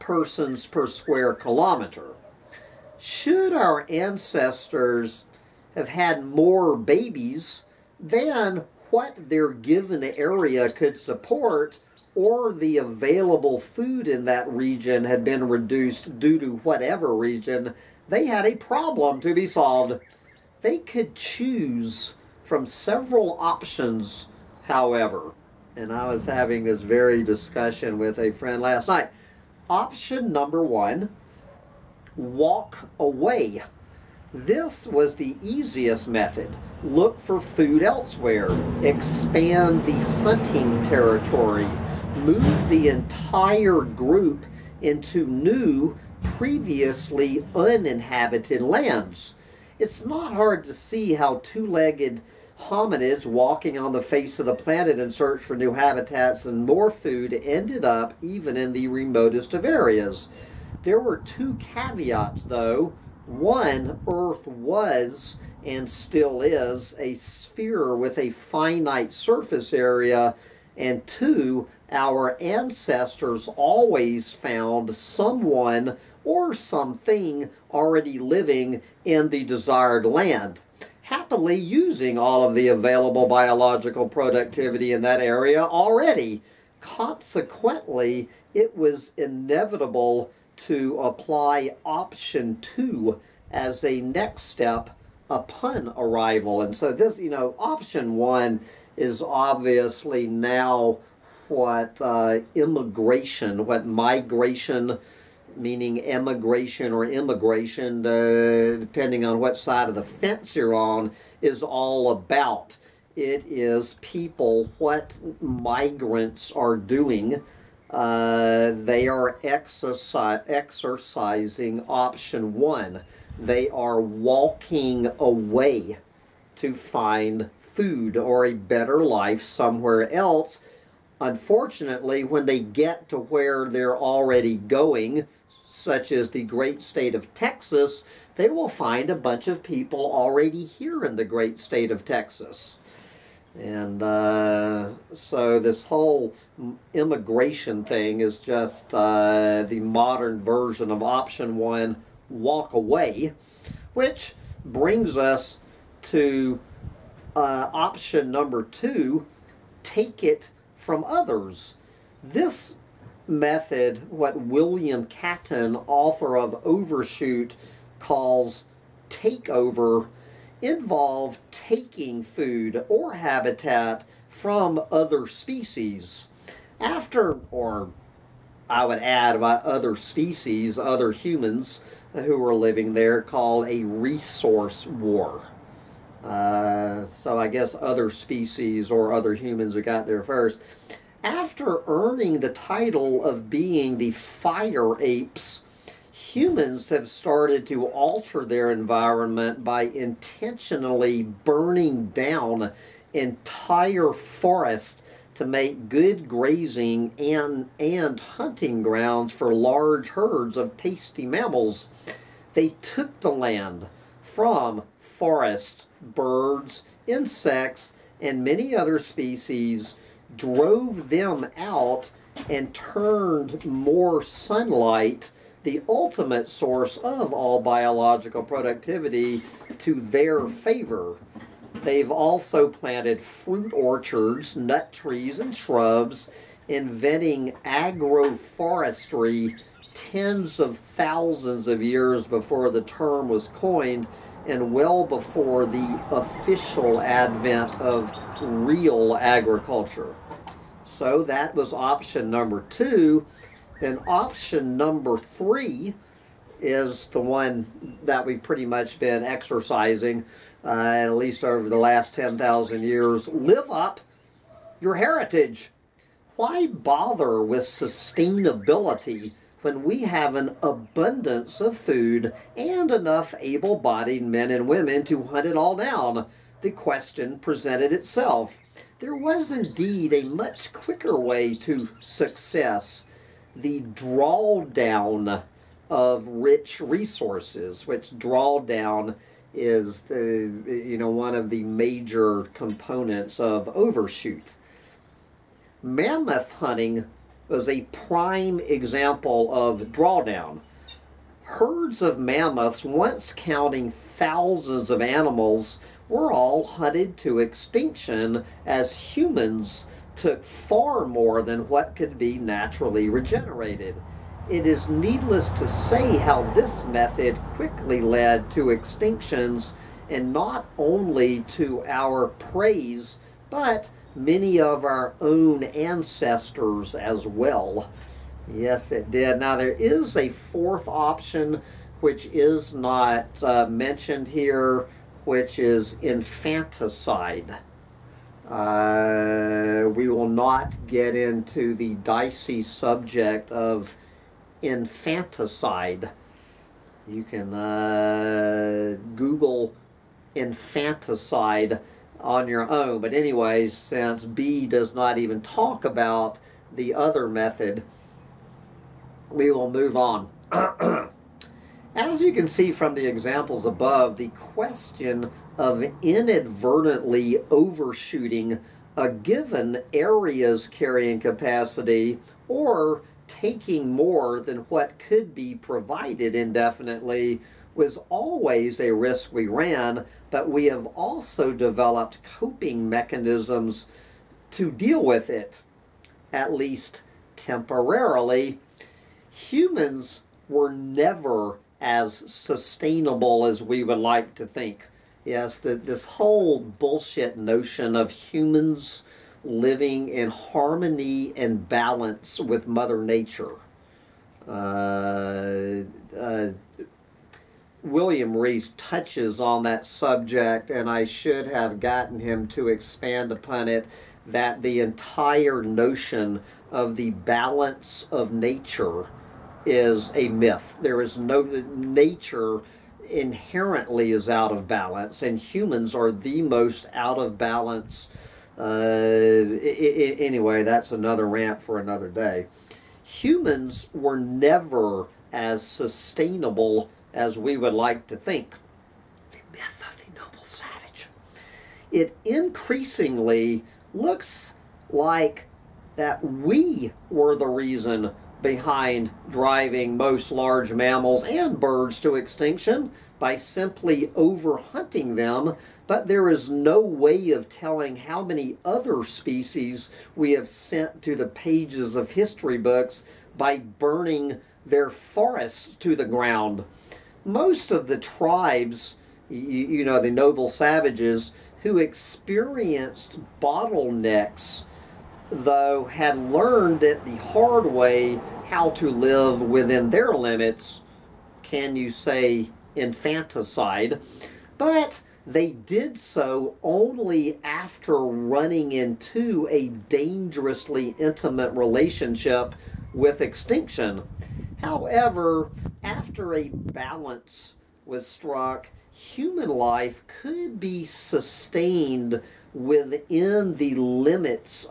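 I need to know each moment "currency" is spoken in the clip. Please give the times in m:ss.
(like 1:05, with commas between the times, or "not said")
not said.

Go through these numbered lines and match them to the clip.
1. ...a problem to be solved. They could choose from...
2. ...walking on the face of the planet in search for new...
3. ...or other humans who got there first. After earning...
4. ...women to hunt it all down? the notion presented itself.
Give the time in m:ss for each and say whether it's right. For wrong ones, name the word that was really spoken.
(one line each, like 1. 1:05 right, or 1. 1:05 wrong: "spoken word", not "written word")
1. 0:18 right
2. 0:53 right
3. 3:08 right
4. 4:34 wrong: "question", not "notion".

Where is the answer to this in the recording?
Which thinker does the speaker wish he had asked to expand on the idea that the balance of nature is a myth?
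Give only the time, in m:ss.
6:47.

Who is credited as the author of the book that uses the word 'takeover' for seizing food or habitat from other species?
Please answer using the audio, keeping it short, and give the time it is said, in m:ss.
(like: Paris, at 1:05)
William Catton, at 2:44.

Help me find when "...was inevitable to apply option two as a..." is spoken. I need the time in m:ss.
1:28.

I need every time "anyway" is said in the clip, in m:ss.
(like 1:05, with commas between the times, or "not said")
5:53, 7:10.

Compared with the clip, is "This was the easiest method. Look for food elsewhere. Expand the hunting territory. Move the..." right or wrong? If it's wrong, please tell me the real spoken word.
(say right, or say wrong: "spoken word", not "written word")
right.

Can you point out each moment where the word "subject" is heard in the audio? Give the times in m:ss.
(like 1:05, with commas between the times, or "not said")
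5:42, 6:49.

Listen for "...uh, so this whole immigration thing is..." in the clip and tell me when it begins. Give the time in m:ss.
2:24.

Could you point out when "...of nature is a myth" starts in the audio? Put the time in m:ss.
6:58.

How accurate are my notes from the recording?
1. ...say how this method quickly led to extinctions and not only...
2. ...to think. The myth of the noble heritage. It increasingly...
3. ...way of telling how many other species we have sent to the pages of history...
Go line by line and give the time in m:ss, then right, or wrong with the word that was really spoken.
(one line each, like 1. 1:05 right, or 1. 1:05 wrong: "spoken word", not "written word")
1. 5:15 right
2. 7:18 wrong: "savage", not "heritage"
3. 7:36 right.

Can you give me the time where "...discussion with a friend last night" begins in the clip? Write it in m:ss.
0:27.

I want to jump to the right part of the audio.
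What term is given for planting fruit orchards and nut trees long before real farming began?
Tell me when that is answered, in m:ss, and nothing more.
3:57.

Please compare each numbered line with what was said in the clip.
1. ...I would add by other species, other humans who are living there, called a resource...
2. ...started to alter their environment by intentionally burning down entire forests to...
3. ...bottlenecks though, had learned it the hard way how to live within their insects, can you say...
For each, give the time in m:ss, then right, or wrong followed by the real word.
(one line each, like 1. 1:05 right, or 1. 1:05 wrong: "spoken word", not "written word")
1. 2:58 right
2. 3:17 right
3. 7:53 wrong: "limits", not "insects".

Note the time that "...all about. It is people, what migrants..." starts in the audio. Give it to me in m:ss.
1:51.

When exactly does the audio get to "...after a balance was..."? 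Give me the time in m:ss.
8:15.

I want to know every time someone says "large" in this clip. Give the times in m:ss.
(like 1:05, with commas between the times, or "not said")
3:29, 7:30.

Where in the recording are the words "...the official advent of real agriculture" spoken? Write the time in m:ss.
4:05.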